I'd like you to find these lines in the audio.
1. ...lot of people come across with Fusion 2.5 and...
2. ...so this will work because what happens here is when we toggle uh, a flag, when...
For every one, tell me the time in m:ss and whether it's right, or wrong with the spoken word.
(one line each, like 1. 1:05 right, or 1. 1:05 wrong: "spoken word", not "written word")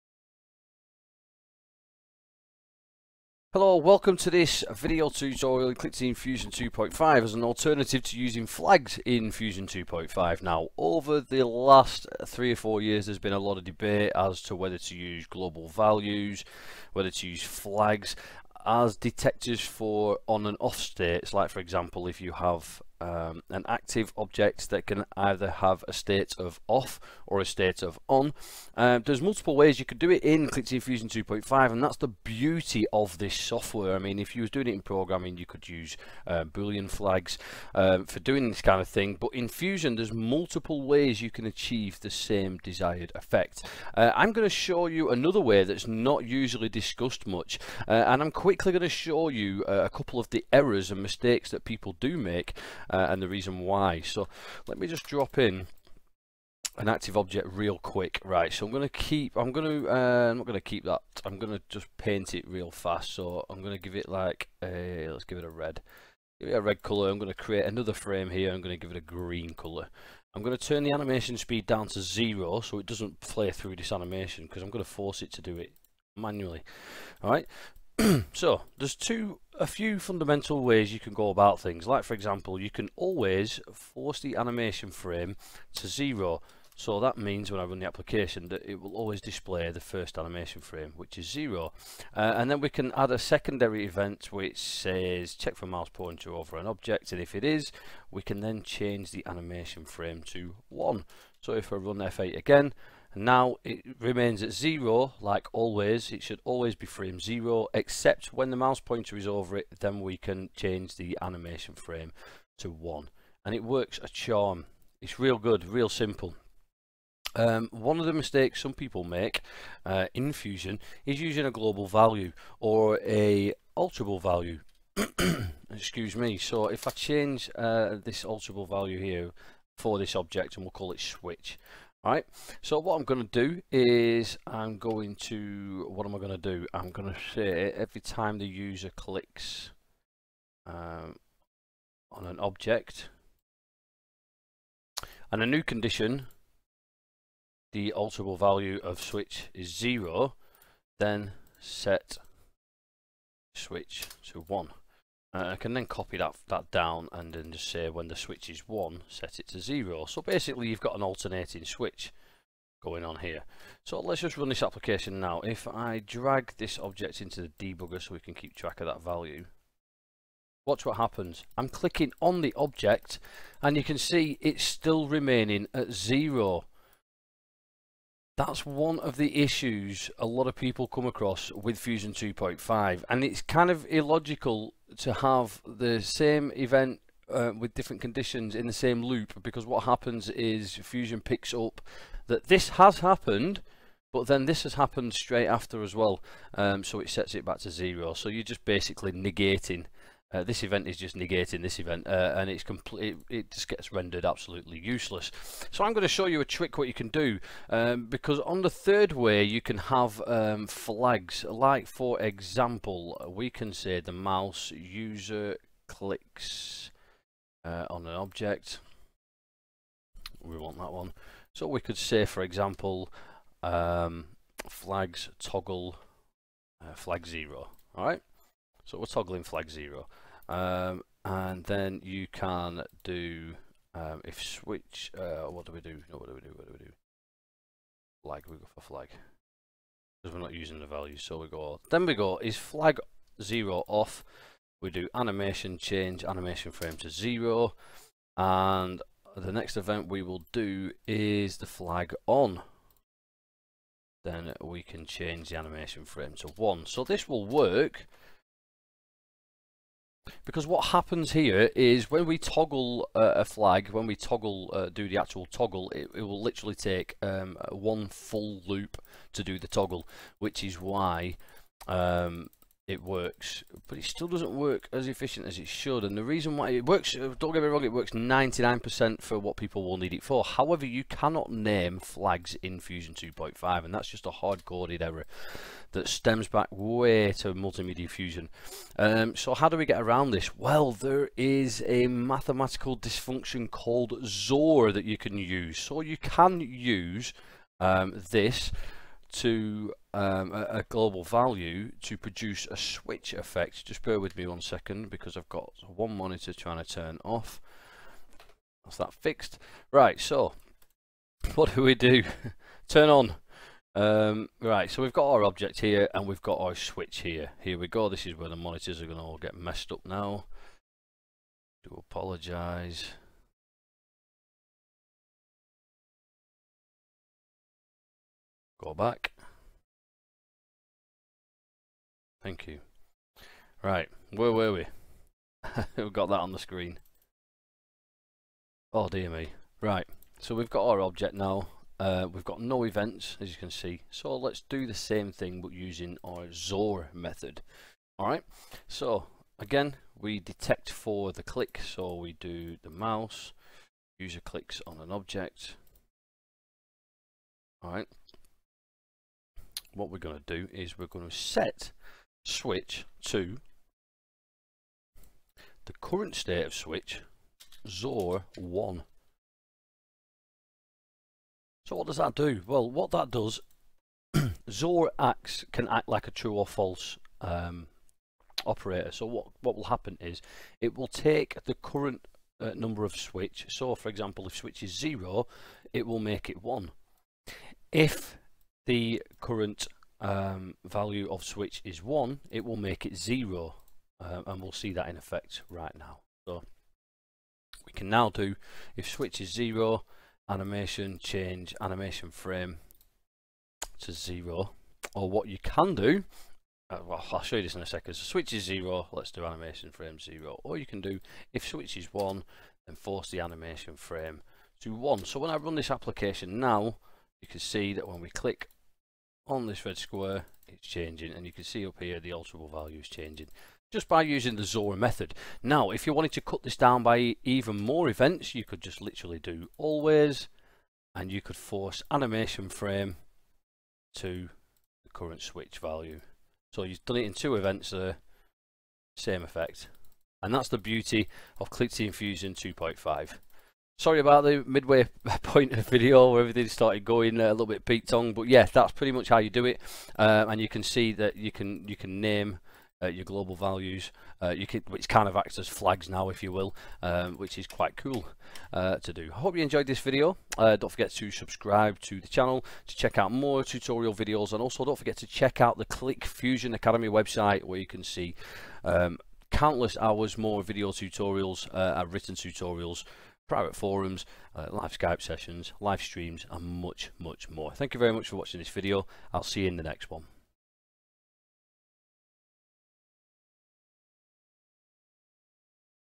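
1. 3:00 right
2. 4:16 right.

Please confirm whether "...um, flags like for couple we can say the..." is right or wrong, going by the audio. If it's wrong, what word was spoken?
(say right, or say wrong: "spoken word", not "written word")
wrong: "example", not "couple".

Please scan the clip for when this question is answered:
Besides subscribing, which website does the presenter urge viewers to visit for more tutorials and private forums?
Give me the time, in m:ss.
7:45.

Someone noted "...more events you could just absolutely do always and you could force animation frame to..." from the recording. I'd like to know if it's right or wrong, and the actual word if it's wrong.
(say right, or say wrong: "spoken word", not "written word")
wrong: "literally", not "absolutely".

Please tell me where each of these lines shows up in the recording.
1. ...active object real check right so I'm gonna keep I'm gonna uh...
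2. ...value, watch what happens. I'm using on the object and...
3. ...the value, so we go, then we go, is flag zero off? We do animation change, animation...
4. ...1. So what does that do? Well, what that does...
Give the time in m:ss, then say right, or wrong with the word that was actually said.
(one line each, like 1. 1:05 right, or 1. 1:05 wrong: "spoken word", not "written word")
1. 0:56 wrong: "quick", not "check"
2. 2:49 wrong: "clicking", not "using"
3. 4:00 right
4. 6:08 right.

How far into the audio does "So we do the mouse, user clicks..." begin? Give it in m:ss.
5:51.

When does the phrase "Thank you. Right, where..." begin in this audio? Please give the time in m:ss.
5:32.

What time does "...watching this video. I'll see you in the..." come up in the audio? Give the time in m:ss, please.
7:58.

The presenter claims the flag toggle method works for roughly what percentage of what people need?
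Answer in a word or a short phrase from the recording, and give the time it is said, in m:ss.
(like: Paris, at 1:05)
99%, at 4:38.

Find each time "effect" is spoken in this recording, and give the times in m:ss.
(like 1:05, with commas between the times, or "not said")
0:43, 5:03, 6:35, 7:19.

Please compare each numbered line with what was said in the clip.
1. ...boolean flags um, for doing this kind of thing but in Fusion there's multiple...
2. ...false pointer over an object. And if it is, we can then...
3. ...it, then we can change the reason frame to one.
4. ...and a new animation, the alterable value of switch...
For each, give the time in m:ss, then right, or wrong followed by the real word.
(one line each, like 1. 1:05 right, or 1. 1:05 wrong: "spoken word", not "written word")
1. 0:36 right
2. 1:35 wrong: "mouse", not "false"
3. 1:49 wrong: "animation", not "reason"
4. 2:25 wrong: "condition", not "animation".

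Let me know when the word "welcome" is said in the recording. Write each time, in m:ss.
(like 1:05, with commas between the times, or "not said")
0:03.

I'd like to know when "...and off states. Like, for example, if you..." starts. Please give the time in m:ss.
0:20.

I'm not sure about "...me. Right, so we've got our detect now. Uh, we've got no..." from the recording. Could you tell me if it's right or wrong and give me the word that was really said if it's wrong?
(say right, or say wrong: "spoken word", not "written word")
wrong: "object", not "detect".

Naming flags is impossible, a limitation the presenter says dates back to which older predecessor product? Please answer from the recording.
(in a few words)
Multimedia Fusion.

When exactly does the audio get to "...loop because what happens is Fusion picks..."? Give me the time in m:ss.
3:09.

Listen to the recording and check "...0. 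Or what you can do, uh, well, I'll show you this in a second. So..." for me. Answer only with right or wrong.
right.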